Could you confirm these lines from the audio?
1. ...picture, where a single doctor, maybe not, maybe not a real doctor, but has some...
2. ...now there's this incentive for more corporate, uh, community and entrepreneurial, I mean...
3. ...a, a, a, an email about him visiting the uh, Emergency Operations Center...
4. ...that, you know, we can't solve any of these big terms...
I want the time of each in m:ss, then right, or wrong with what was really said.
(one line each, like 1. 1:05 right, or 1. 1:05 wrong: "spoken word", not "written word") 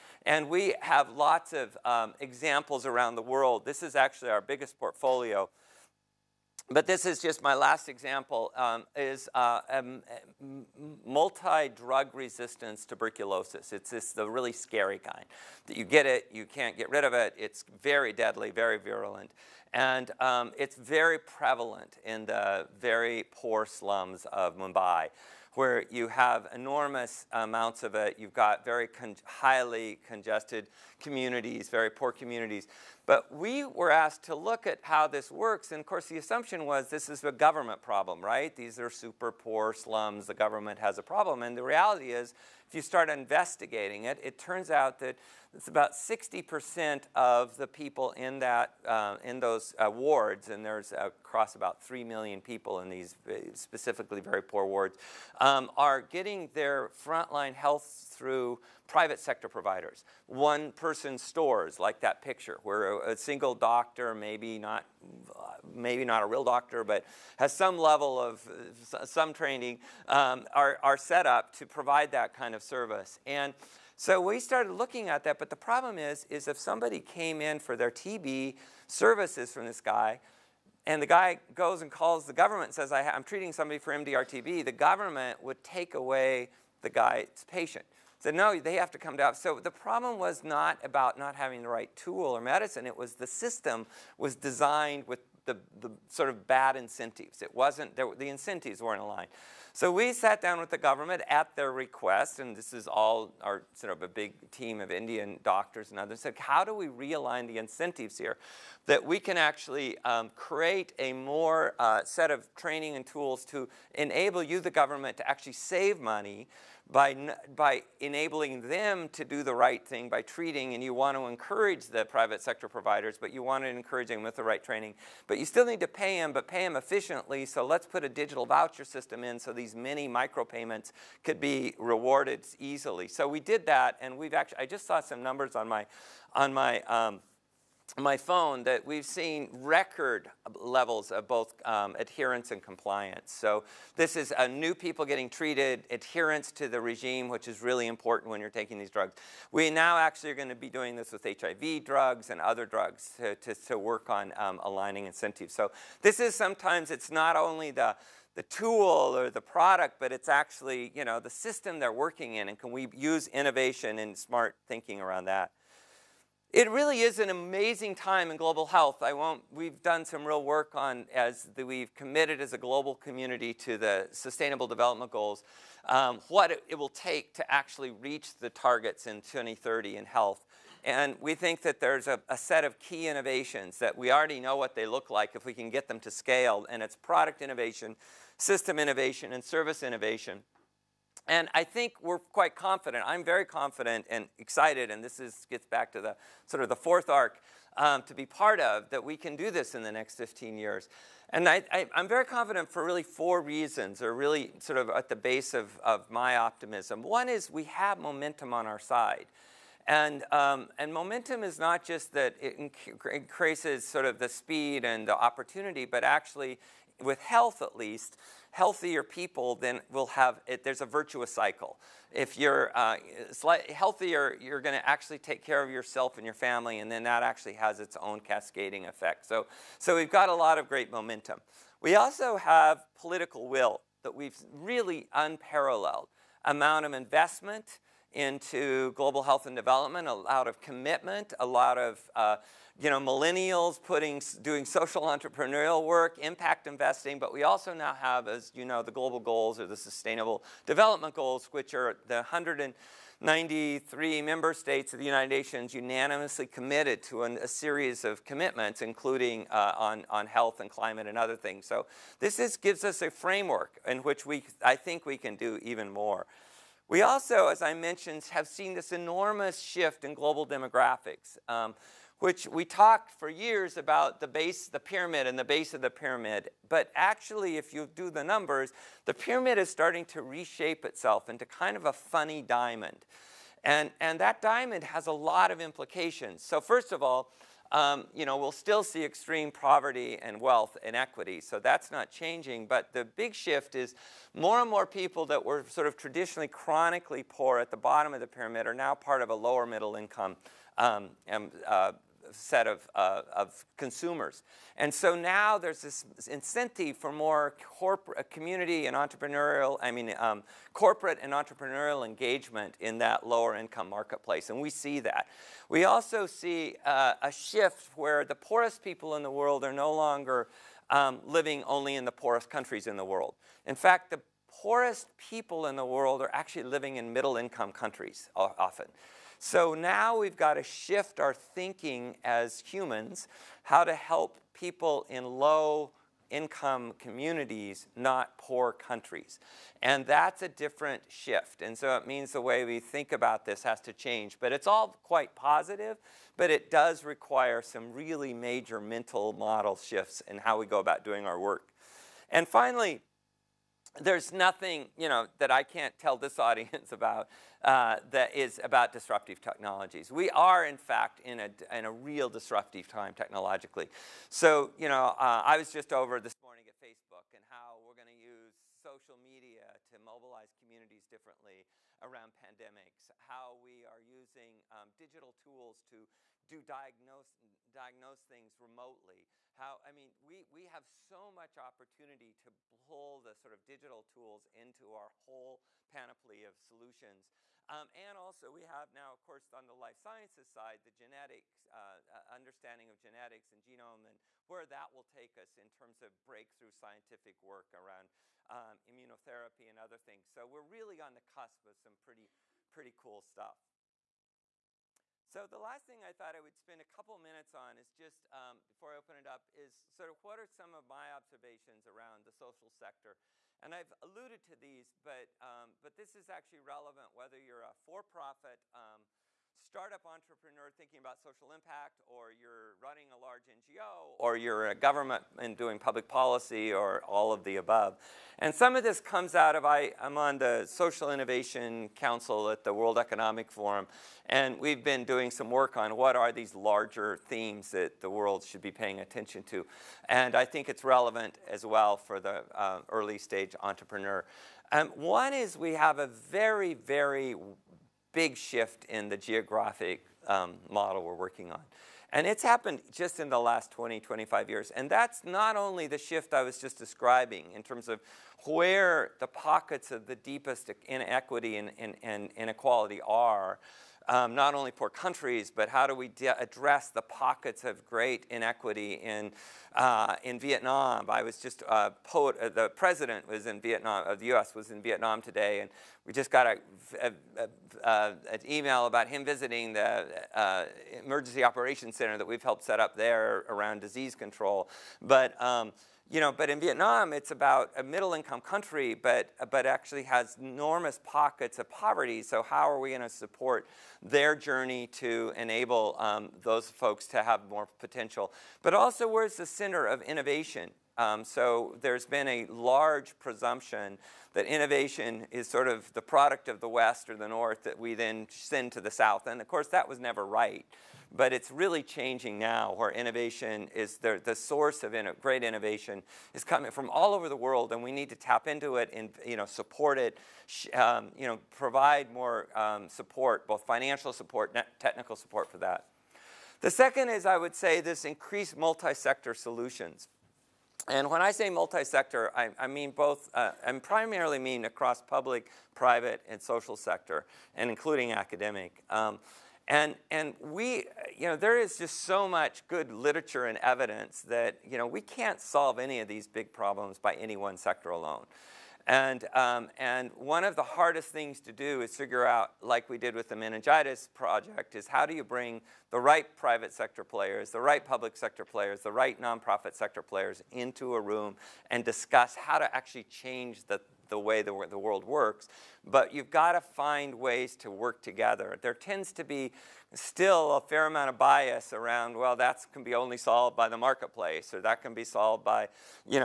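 1. 1:02 right
2. 5:05 right
3. 7:56 right
4. 9:04 wrong: "problems", not "terms".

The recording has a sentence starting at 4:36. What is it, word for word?
But actually, if you do the numbers, the pyramid is starting to reshape itself into kind of a funny diamond.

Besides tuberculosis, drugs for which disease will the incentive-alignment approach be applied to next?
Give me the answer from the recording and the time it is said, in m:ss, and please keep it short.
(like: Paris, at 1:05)
HIV, at 2:31.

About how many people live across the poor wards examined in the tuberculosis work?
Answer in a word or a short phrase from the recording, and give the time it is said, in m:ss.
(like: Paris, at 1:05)
3 million, at 0:51.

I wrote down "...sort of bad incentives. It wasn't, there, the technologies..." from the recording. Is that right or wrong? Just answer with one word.
wrong.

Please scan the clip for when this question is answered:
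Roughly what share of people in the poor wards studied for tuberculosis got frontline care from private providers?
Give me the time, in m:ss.
0:45.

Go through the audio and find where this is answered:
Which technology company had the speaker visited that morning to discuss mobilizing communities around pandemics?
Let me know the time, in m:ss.
6:06.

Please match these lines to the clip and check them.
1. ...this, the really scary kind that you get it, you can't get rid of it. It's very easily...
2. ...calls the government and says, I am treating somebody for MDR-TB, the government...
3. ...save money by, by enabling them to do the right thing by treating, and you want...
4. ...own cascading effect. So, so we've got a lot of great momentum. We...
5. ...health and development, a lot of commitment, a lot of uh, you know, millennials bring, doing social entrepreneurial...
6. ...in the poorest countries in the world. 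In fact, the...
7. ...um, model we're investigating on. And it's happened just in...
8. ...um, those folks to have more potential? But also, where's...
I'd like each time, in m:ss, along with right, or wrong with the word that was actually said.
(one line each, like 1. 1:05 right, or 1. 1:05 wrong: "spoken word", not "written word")
1. 0:13 wrong: "deadly", not "easily"
2. 1:21 right
3. 1:55 right
4. 3:48 right
5. 3:59 wrong: "putting", not "bring"
6. 5:21 right
7. 7:30 wrong: "working", not "investigating"
8. 8:15 right.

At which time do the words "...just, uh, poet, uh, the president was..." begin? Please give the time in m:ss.
7:51.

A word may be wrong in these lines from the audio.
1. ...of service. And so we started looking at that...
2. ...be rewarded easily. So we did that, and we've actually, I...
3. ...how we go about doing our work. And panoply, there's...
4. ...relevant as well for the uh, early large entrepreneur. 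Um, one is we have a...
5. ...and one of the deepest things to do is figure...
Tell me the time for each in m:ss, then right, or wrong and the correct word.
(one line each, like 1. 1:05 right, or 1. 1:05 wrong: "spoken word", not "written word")
1. 1:12 right
2. 2:11 right
3. 5:50 wrong: "finally", not "panoply"
4. 7:20 wrong: "stage", not "large"
5. 9:09 wrong: "hardest", not "deepest".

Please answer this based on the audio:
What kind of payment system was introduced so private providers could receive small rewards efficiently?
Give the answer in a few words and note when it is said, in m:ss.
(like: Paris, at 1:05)
digital voucher system, at 2:08.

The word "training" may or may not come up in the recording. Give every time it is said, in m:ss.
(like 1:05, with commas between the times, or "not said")
1:09, 1:52, 2:04.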